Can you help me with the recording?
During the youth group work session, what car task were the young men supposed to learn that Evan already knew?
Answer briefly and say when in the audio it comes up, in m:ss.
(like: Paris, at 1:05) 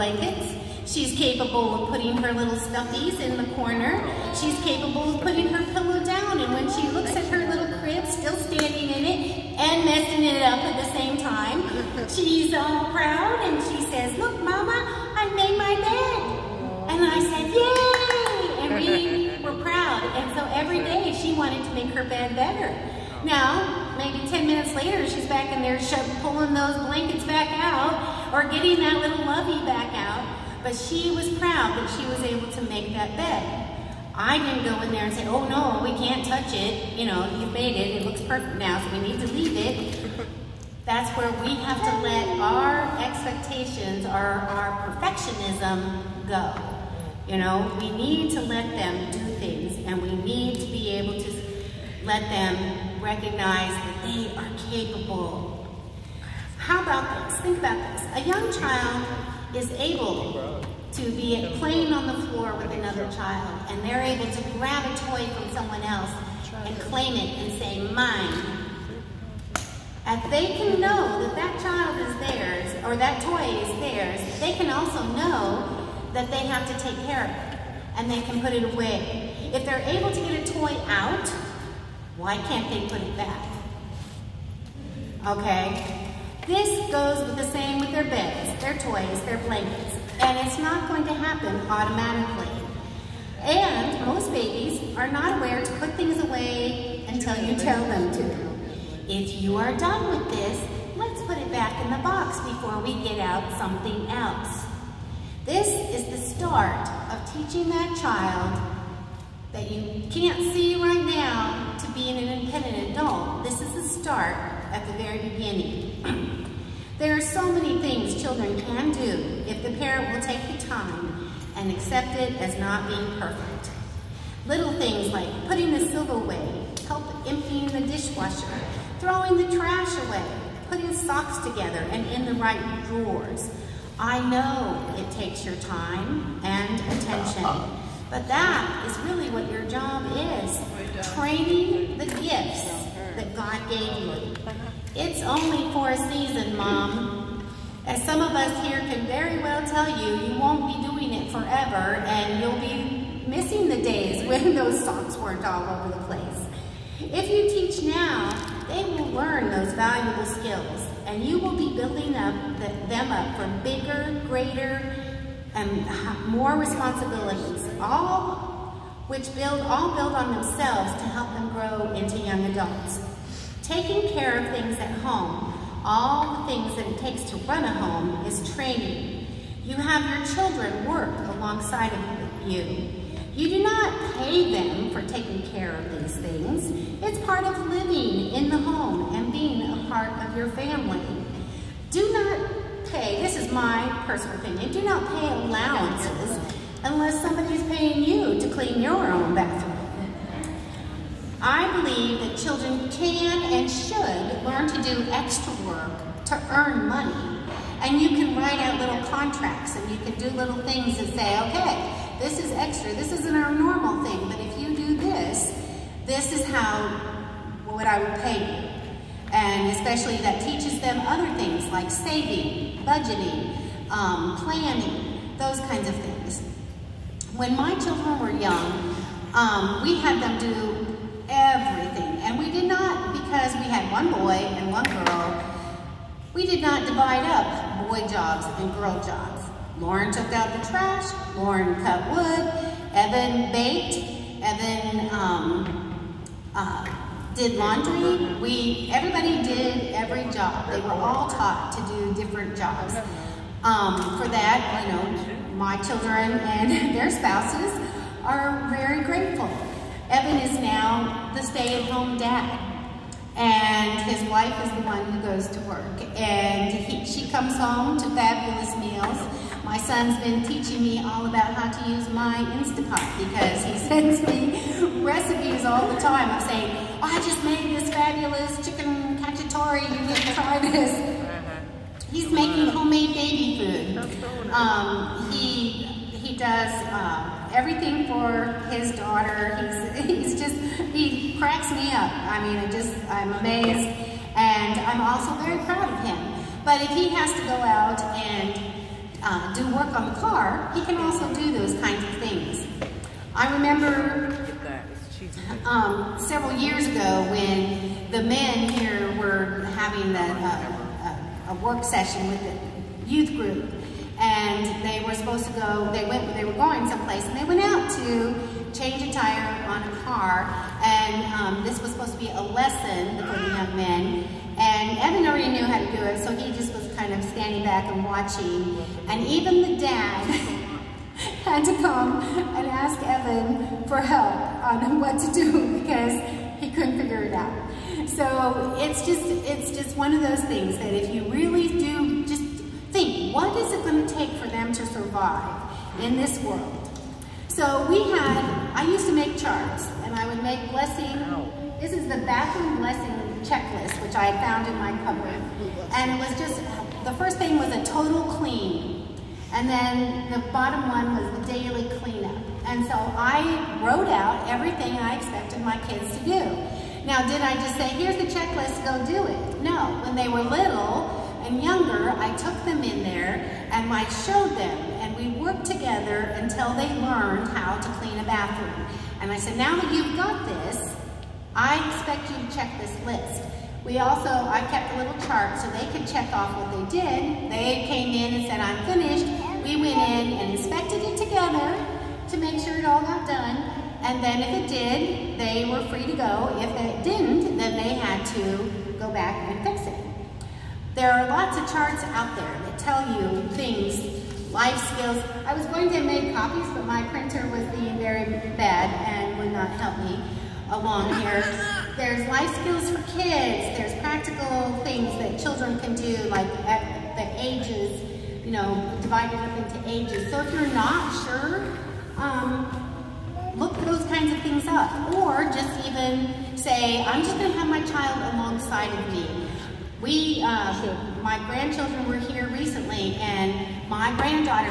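change a tire, at 5:18.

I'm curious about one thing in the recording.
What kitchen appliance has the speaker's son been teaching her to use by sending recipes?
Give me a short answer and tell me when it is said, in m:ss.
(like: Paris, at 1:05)
Instapot, at 4:32.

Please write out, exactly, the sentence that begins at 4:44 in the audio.
Um, he, he does um, everything for his daughter.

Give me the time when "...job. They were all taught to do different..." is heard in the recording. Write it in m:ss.
4:10.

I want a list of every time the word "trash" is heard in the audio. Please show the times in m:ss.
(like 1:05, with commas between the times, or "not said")
2:09, 4:00.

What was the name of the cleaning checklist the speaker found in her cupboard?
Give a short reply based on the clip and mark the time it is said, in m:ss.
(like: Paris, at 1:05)
bathroom blessing checklist, at 5:52.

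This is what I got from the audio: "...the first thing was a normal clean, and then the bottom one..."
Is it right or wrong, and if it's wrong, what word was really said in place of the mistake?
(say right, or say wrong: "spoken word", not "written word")
wrong: "total", not "normal".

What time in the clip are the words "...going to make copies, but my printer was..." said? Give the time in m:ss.
6:45.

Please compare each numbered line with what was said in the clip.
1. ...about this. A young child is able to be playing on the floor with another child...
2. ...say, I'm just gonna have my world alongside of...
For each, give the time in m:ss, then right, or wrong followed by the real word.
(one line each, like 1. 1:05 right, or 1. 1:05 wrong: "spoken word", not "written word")
1. 0:57 right
2. 7:06 wrong: "child", not "world".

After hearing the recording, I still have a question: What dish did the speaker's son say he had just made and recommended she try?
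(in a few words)
chicken cacciatore.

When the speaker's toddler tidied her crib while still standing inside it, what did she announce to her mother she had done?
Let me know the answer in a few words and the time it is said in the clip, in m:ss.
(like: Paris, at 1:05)
made my bed, at 0:15.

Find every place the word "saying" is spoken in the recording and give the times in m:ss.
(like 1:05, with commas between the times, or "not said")
4:36.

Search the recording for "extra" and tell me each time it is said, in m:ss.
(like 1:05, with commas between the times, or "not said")
3:25, 3:32.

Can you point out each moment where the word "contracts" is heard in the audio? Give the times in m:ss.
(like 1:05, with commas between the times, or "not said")
3:29.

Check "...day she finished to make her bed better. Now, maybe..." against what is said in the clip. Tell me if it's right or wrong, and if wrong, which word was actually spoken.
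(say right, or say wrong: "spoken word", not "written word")
wrong: "wanted", not "finished".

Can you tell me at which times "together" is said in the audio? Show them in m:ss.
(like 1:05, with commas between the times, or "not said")
2:11, 6:15, 6:31.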